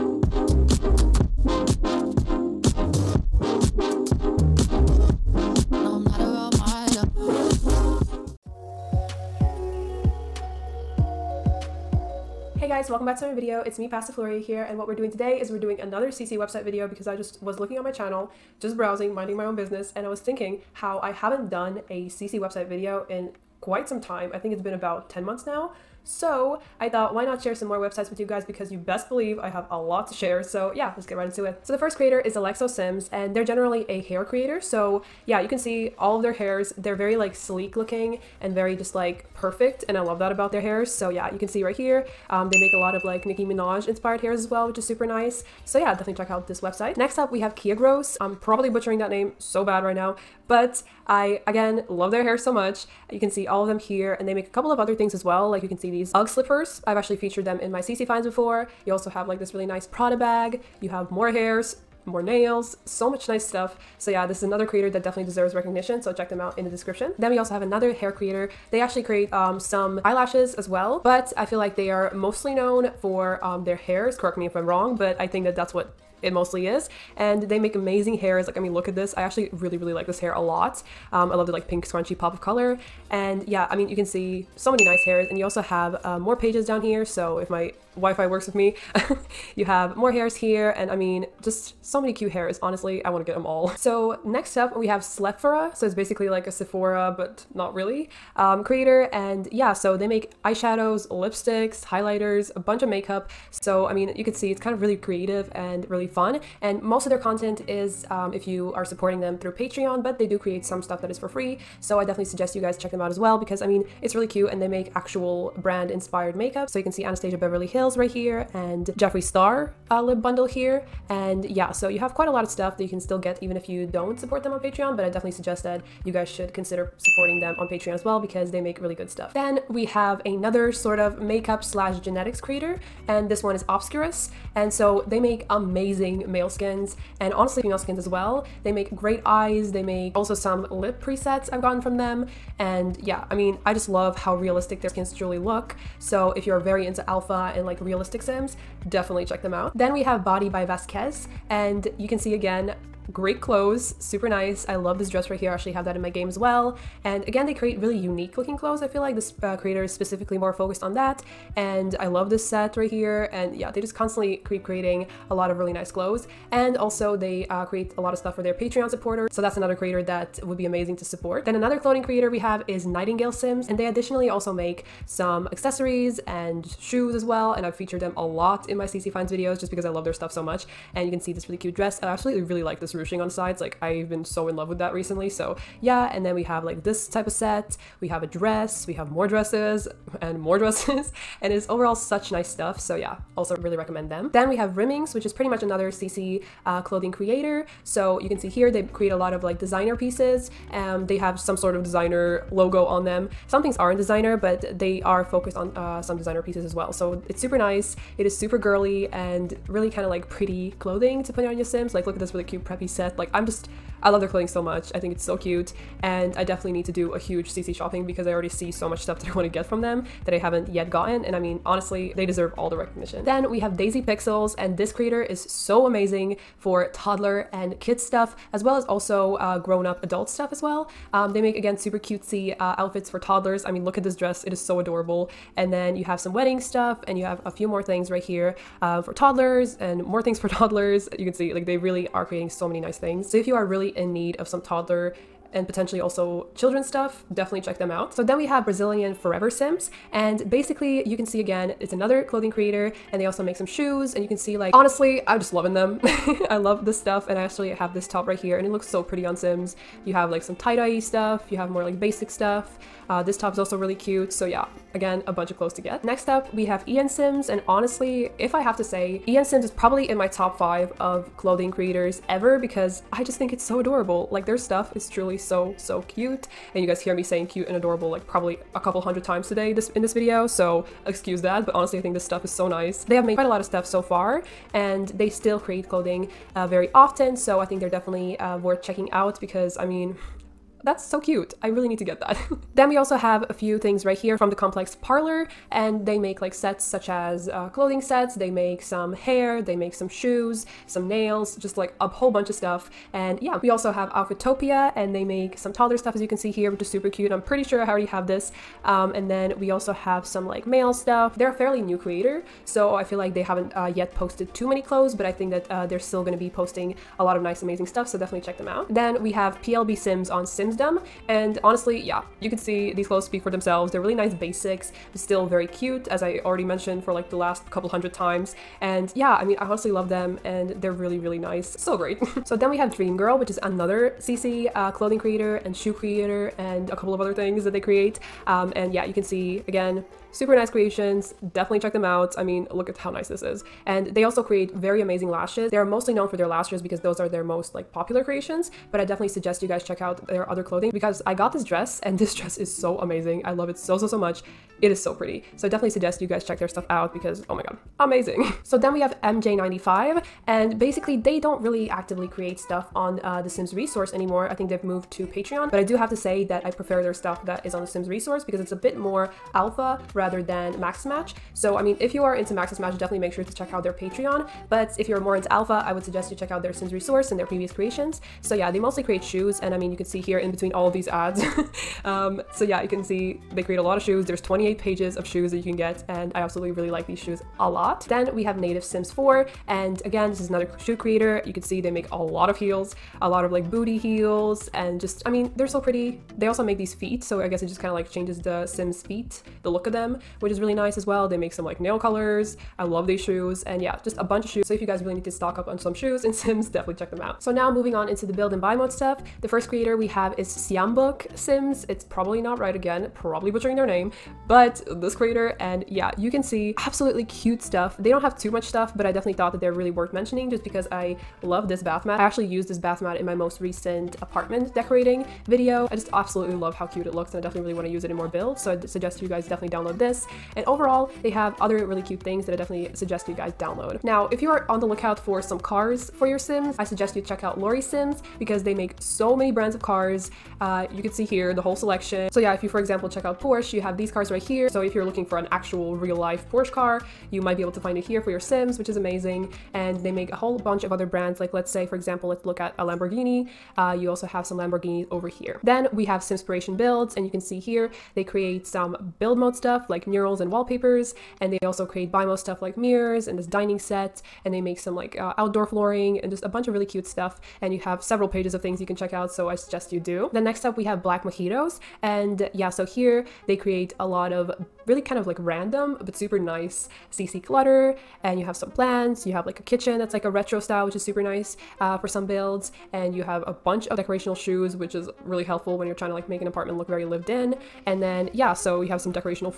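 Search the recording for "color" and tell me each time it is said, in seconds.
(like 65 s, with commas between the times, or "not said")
82 s, 401 s.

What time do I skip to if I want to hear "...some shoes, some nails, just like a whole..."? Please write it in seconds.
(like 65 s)
299 s.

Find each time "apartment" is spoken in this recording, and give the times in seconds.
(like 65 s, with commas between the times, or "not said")
424 s, 486 s.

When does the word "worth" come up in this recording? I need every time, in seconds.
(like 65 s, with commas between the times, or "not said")
288 s, 419 s.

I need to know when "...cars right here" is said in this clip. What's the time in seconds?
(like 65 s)
444 s.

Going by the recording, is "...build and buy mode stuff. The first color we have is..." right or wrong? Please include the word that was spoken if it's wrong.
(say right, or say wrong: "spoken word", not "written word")
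wrong: "creator", not "color".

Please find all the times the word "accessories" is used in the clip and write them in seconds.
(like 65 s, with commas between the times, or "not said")
175 s.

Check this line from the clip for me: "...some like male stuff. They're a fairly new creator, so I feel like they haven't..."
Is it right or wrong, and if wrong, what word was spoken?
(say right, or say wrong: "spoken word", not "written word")
right.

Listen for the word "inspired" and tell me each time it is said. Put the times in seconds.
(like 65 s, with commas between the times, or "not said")
43 s, 115 s.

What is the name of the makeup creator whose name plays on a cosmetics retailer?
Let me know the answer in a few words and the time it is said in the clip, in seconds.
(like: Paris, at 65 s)
Slephora, at 94 s.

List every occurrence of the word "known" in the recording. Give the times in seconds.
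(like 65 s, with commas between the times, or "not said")
72 s, 346 s.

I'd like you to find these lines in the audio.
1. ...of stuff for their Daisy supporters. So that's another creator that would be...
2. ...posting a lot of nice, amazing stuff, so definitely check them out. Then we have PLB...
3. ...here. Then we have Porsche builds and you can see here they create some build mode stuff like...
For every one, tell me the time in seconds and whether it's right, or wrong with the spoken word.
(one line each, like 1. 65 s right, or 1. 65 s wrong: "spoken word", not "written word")
1. 168 s wrong: "Patreon", not "Daisy"
2. 316 s right
3. 455 s wrong: "Simspiration", not "Porsche".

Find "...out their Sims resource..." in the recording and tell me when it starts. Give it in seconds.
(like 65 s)
376 s.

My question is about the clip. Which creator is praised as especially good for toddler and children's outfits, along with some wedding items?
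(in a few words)
Daisy Pixels.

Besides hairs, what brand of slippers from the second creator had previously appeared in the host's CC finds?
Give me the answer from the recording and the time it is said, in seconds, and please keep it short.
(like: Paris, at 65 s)
UGG, at 56 s.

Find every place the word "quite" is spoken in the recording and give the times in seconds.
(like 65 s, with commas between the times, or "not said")
23 s, 122 s, 283 s.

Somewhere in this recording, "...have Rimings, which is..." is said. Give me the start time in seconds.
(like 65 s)
194 s.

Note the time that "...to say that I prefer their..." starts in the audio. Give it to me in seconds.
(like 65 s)
366 s.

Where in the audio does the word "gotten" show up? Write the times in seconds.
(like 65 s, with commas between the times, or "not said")
141 s, 220 s.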